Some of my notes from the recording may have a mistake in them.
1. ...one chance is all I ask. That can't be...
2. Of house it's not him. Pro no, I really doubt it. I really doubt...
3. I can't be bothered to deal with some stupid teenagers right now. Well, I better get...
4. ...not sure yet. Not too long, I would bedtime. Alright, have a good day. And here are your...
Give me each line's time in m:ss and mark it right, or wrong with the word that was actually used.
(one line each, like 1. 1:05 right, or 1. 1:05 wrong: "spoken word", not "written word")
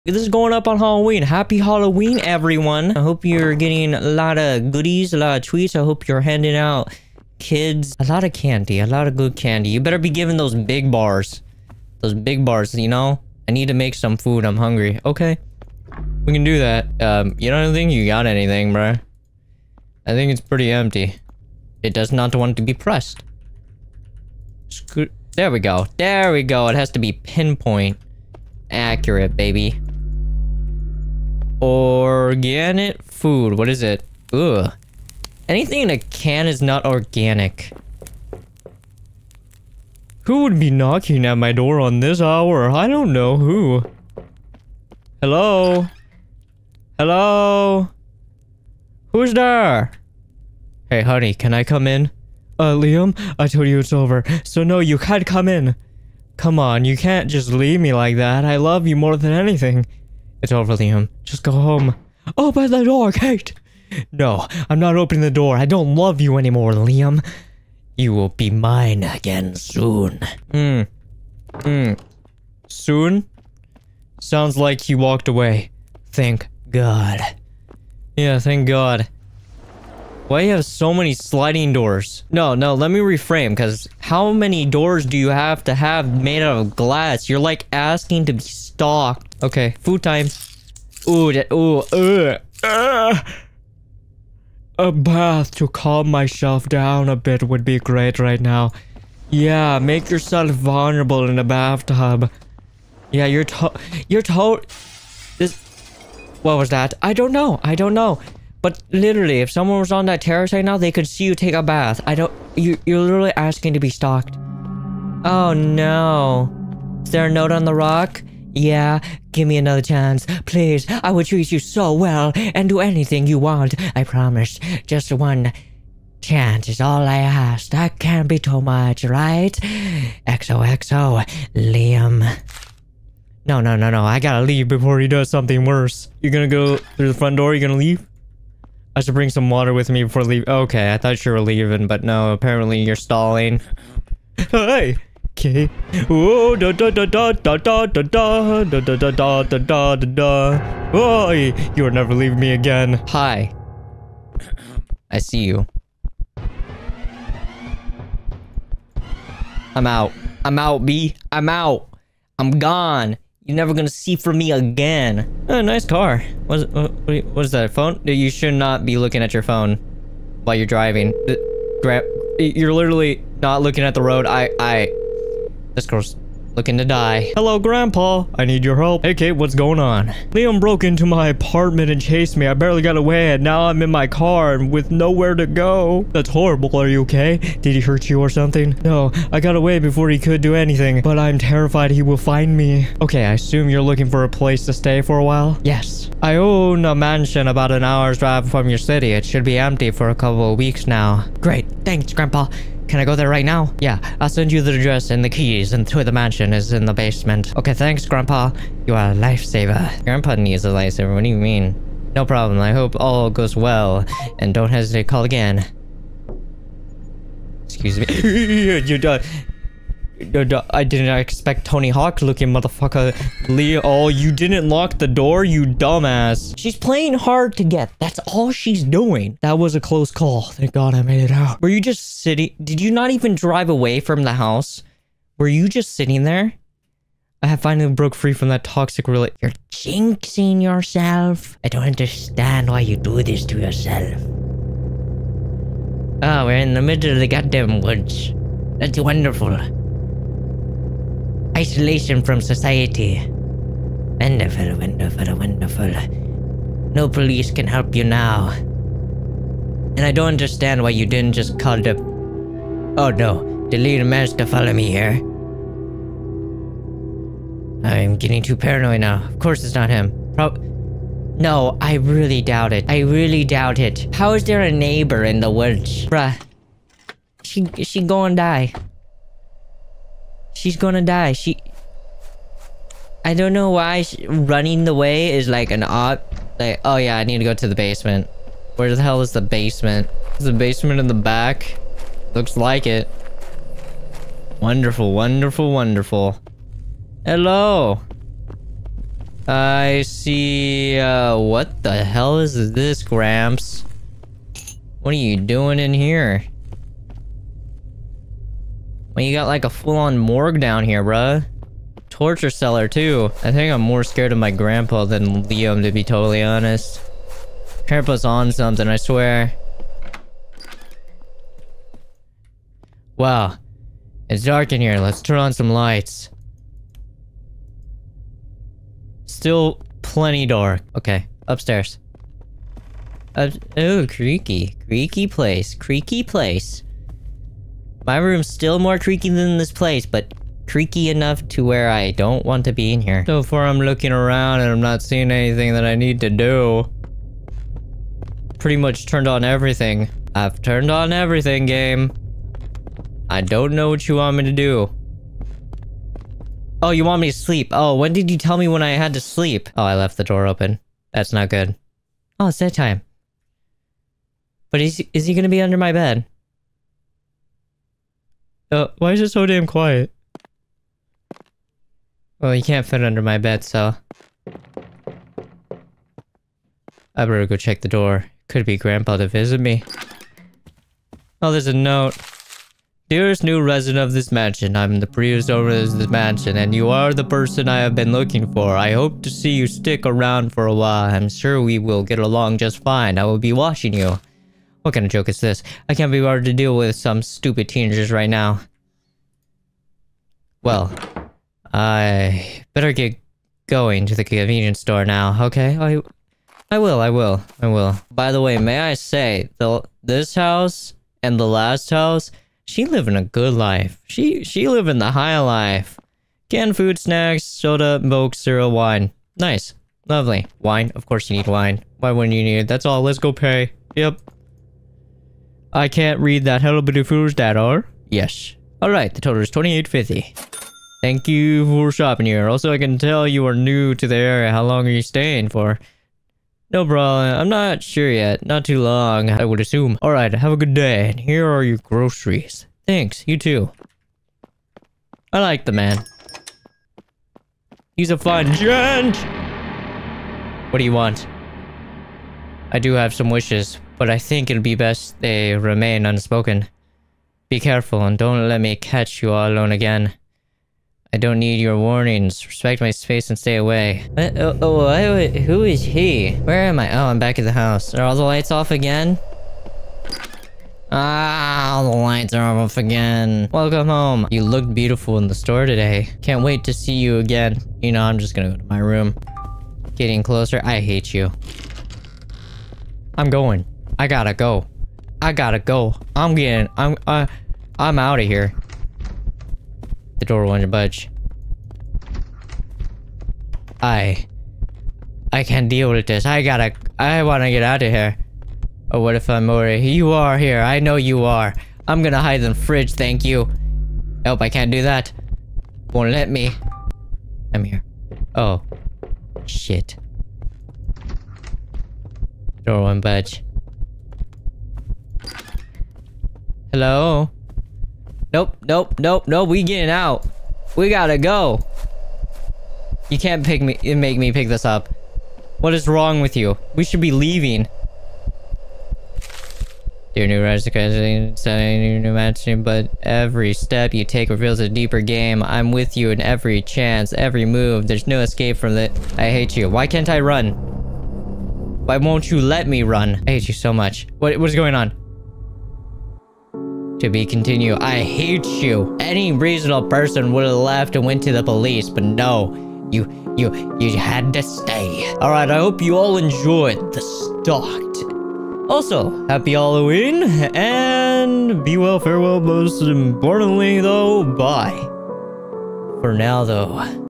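1. 2:05 right
2. 4:29 wrong: "course", not "house"
3. 6:35 right
4. 7:17 wrong: "assume", not "bedtime".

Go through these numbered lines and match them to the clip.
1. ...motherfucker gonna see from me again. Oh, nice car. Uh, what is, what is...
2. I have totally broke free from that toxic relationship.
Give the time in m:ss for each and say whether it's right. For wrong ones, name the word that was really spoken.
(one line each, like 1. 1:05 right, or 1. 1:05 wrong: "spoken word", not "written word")
1. 2:43 wrong: "never", not "motherfucker"
2. 3:57 wrong: "finally", not "totally".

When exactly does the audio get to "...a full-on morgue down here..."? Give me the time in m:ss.
5:09.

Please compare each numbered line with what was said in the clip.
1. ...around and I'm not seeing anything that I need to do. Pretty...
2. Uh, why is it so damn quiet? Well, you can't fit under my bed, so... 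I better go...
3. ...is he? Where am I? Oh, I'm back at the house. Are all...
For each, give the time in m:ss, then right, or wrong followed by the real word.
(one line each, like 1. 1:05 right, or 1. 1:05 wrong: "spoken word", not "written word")
1. 5:44 right
2. 6:08 right
3. 7:45 right.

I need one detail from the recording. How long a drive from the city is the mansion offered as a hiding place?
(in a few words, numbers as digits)
an hour.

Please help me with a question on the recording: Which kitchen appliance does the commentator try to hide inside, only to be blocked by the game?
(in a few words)
fridge.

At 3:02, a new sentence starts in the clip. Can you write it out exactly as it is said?
I barely got away, and now I'm in my car and with nowhere to go.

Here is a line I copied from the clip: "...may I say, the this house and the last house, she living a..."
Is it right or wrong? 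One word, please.
right.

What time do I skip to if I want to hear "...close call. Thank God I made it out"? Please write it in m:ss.
3:49.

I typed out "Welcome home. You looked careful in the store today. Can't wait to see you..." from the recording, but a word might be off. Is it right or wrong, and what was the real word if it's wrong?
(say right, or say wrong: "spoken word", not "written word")
wrong: "beautiful", not "careful".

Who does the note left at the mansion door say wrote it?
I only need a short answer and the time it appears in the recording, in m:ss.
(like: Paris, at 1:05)
the previous owner, at 6:25.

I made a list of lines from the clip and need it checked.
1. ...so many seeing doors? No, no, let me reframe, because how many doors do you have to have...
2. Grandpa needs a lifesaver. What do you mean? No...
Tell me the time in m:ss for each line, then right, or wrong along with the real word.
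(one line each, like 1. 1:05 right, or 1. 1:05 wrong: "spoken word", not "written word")
1. 1:20 wrong: "sliding", not "seeing"
2. 3:30 right.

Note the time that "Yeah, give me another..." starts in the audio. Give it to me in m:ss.
1:58.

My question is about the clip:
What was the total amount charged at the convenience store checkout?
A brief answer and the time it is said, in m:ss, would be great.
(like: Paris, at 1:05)
2850, at 7:09.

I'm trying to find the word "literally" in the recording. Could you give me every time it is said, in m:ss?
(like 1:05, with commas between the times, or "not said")
1:48, 1:52, 2:52.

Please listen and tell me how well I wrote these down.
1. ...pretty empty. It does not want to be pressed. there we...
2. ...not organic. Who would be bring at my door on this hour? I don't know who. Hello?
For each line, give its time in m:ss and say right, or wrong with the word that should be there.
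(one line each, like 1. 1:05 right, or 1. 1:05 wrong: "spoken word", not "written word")
1. 0:20 right
2. 0:36 wrong: "knocking", not "bring".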